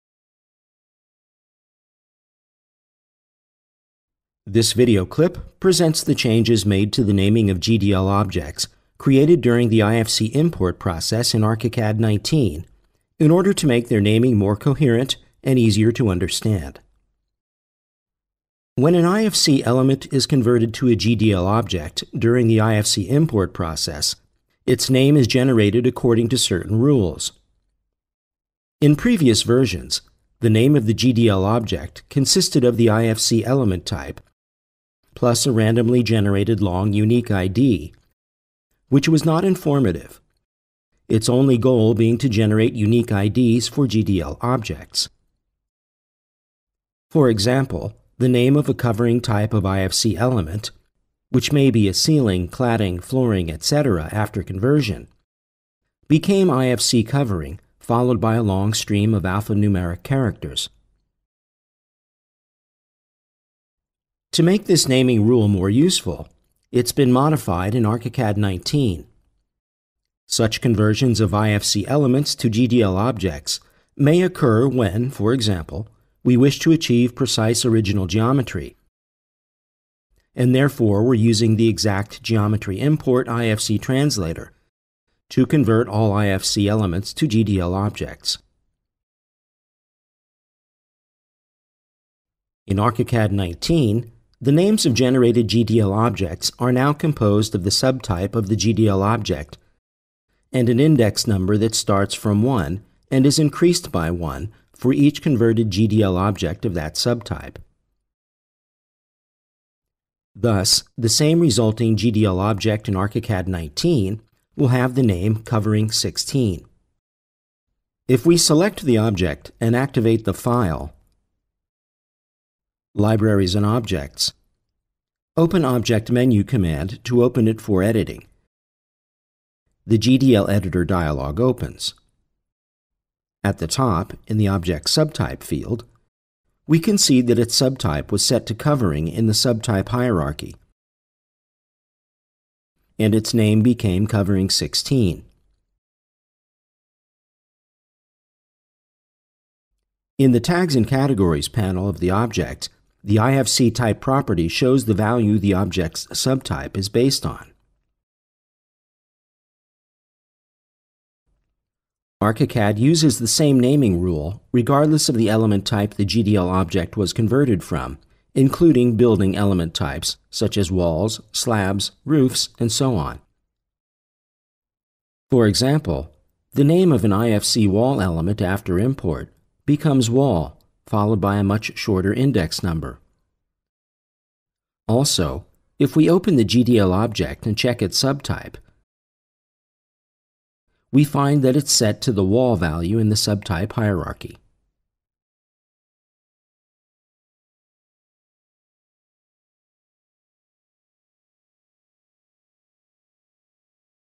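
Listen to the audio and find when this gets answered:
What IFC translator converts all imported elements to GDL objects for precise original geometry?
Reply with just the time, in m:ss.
1:21.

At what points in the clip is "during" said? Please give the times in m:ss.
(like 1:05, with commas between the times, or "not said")
0:09, 0:22.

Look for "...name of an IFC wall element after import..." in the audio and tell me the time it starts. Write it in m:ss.
2:56.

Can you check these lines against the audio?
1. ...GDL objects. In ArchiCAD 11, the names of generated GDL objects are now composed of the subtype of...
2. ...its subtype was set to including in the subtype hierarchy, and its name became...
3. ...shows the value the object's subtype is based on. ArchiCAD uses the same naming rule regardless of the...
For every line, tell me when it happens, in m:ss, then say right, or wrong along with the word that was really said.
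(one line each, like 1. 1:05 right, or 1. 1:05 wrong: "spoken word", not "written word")
1. 1:27 wrong: "19", not "11"
2. 2:17 wrong: "covering", not "including"
3. 2:34 right.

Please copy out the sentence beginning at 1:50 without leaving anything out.
Thus, the same resulting GDL object in ArchiCAD 19 will have the name covering 16.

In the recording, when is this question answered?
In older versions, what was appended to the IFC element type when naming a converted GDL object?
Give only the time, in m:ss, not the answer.
0:35.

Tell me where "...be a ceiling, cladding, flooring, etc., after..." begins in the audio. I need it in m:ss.
0:51.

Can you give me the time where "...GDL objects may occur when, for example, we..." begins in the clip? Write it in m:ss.
1:12.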